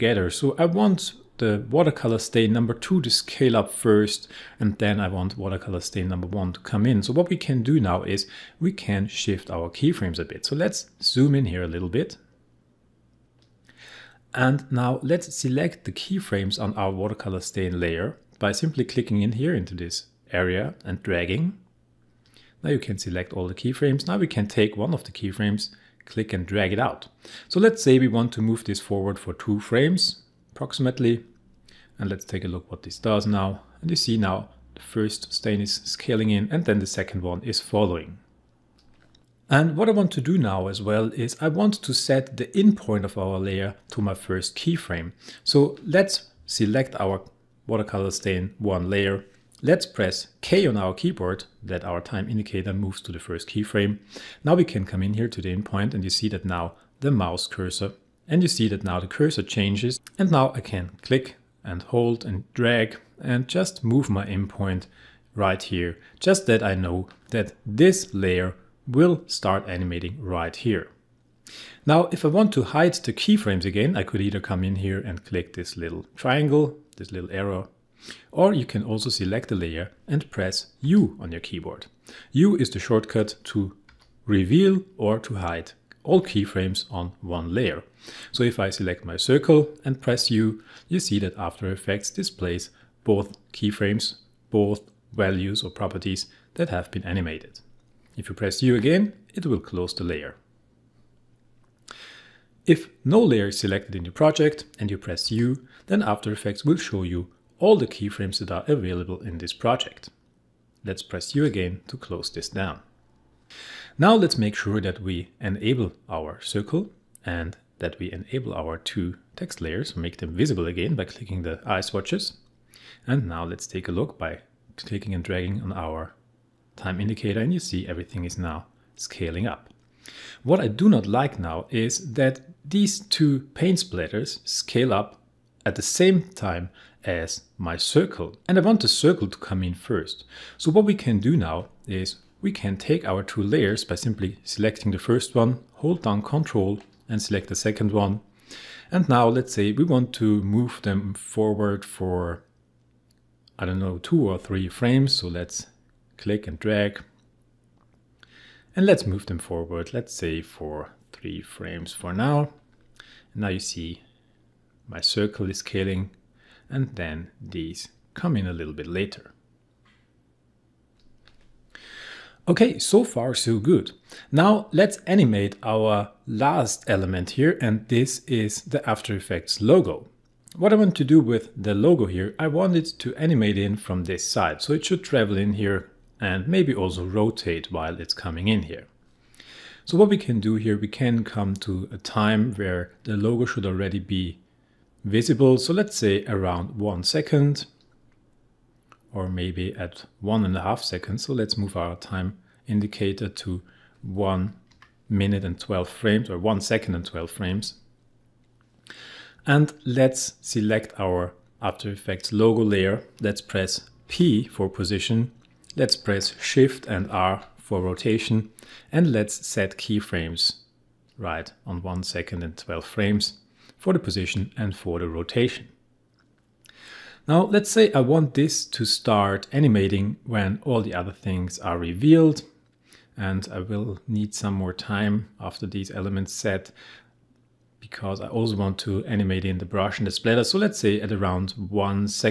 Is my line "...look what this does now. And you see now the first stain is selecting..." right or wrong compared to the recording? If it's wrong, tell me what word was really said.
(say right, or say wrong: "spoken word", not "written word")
wrong: "scaling", not "selecting".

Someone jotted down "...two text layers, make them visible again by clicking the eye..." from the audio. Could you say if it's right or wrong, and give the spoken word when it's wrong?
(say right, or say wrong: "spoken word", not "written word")
right.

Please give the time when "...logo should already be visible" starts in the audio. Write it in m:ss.
3:13.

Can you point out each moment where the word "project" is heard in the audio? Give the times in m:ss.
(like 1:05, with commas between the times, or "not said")
1:44, 1:49.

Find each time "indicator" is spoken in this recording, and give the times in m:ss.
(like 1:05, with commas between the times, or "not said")
0:52, 2:06, 3:22.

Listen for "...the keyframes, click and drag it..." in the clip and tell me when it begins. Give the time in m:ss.
0:25.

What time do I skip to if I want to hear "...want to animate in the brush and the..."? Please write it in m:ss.
3:58.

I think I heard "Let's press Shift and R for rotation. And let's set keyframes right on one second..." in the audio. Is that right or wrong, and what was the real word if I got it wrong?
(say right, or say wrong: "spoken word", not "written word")
right.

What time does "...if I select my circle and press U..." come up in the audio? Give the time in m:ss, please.
1:28.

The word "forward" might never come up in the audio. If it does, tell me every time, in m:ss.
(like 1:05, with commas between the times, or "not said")
0:28, 2:31, 2:39.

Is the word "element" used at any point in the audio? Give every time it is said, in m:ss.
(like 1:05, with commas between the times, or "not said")
2:56, 3:55.